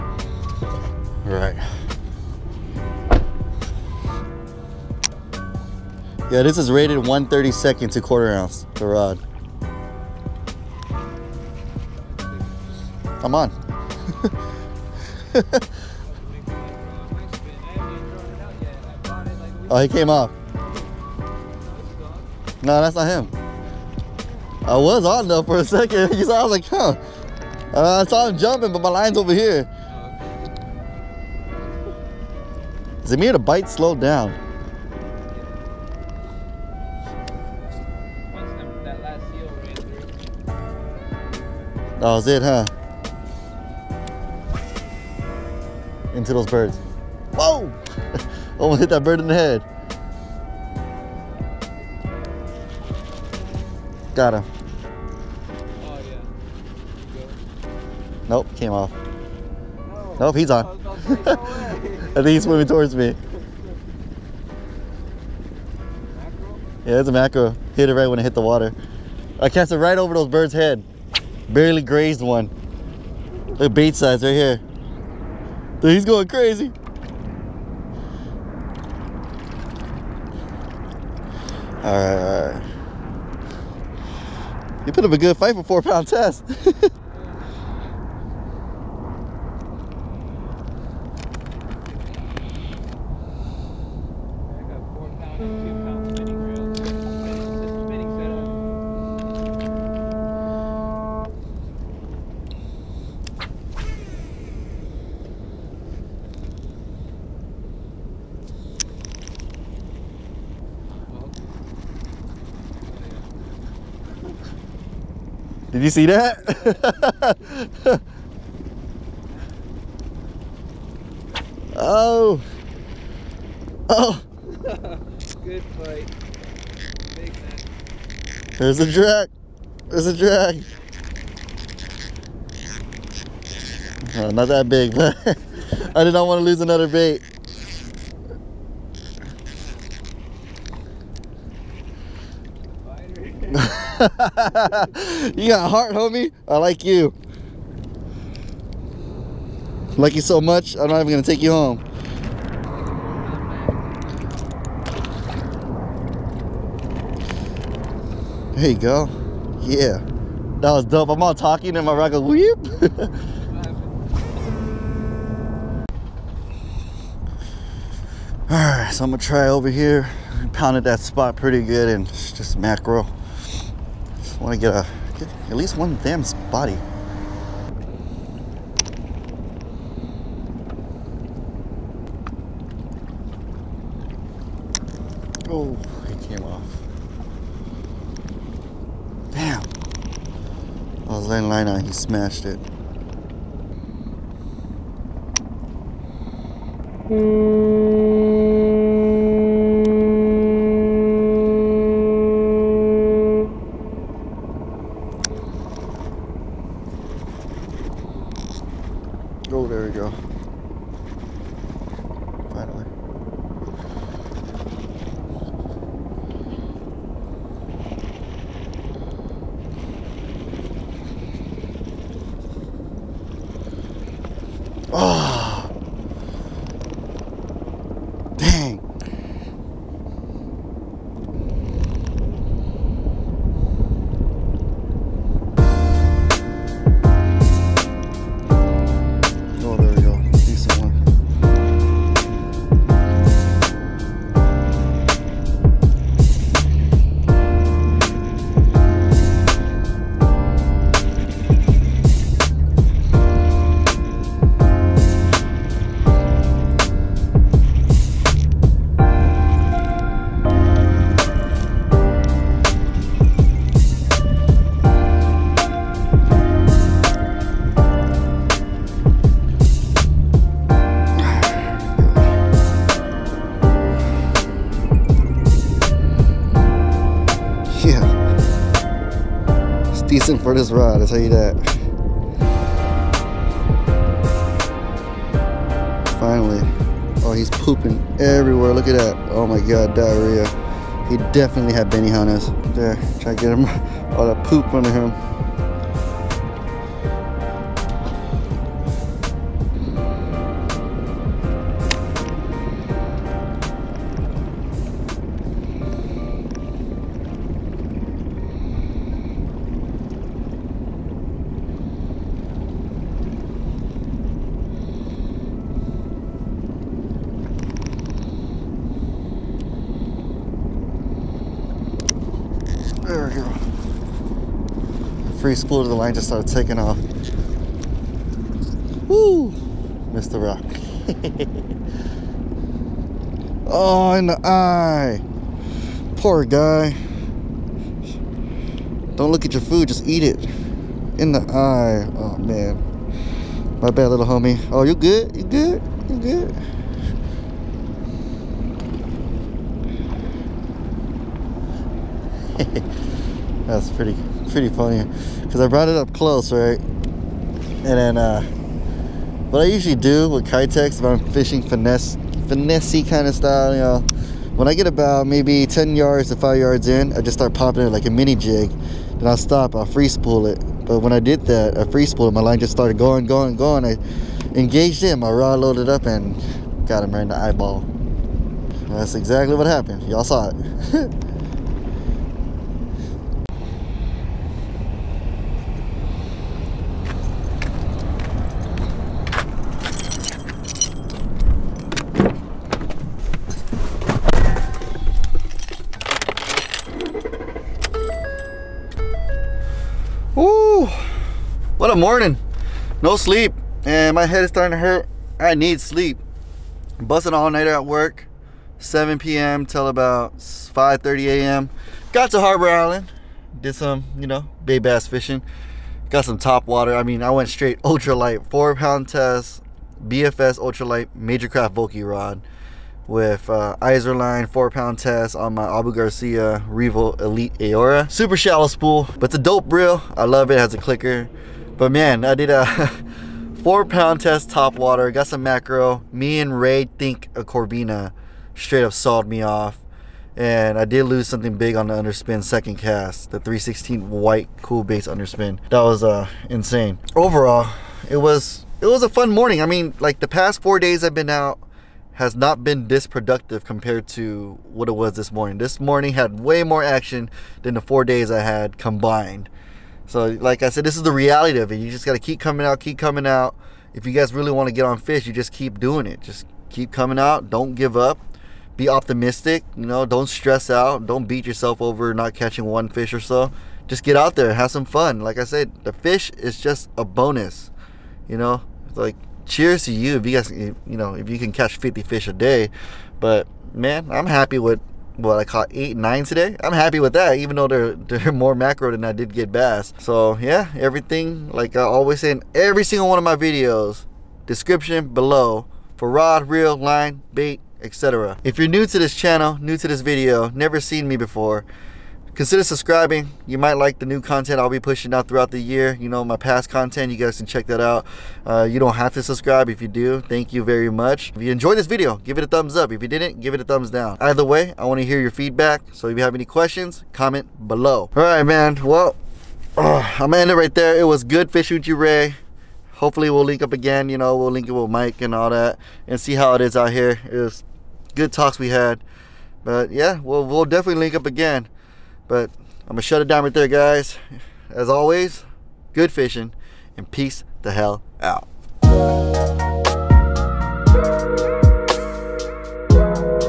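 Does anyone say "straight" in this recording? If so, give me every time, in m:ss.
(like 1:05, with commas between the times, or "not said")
6:57, 7:18.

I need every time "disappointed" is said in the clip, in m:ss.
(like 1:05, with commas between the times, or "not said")
not said.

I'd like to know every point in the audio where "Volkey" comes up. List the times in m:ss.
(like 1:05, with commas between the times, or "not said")
7:01.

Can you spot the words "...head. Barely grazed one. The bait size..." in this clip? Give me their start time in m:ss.
1:10.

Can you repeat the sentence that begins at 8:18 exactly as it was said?
If you're new to this channel, new to this video, never seen me before, Consider subscribing.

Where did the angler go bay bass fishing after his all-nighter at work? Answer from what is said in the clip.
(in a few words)
Harbor Island.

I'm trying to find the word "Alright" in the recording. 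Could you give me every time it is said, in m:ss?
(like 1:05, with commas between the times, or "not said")
2:48.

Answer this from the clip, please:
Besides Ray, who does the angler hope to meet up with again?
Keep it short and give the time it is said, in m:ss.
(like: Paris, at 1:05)
Mike, at 8:44.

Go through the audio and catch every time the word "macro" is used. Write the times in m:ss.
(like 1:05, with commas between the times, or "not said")
1:07, 2:52, 7:15, 8:08.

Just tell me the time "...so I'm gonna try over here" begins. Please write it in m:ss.
2:48.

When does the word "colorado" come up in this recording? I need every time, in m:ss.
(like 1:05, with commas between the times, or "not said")
not said.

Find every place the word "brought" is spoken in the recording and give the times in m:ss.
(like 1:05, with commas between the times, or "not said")
5:55.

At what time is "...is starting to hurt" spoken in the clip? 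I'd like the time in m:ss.
6:44.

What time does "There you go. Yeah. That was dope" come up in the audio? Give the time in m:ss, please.
2:38.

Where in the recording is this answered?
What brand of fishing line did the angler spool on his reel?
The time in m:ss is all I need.
7:03.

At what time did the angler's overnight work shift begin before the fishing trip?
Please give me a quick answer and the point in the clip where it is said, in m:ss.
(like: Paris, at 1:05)
7 p.m., at 6:48.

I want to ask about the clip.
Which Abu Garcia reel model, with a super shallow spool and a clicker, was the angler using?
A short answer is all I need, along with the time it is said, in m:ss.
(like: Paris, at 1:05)
Revo Elite Aurora, at 7:06.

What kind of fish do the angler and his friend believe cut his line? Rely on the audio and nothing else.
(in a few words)
Corvina.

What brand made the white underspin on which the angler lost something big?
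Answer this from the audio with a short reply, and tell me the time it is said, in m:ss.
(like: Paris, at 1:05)
Coolbaits, at 7:24.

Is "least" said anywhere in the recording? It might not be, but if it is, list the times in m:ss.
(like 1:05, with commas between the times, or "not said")
1:01, 2:55.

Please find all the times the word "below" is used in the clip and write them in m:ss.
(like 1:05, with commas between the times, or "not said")
8:15, 8:37.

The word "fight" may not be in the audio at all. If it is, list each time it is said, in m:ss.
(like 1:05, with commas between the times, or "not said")
1:25, 2:05.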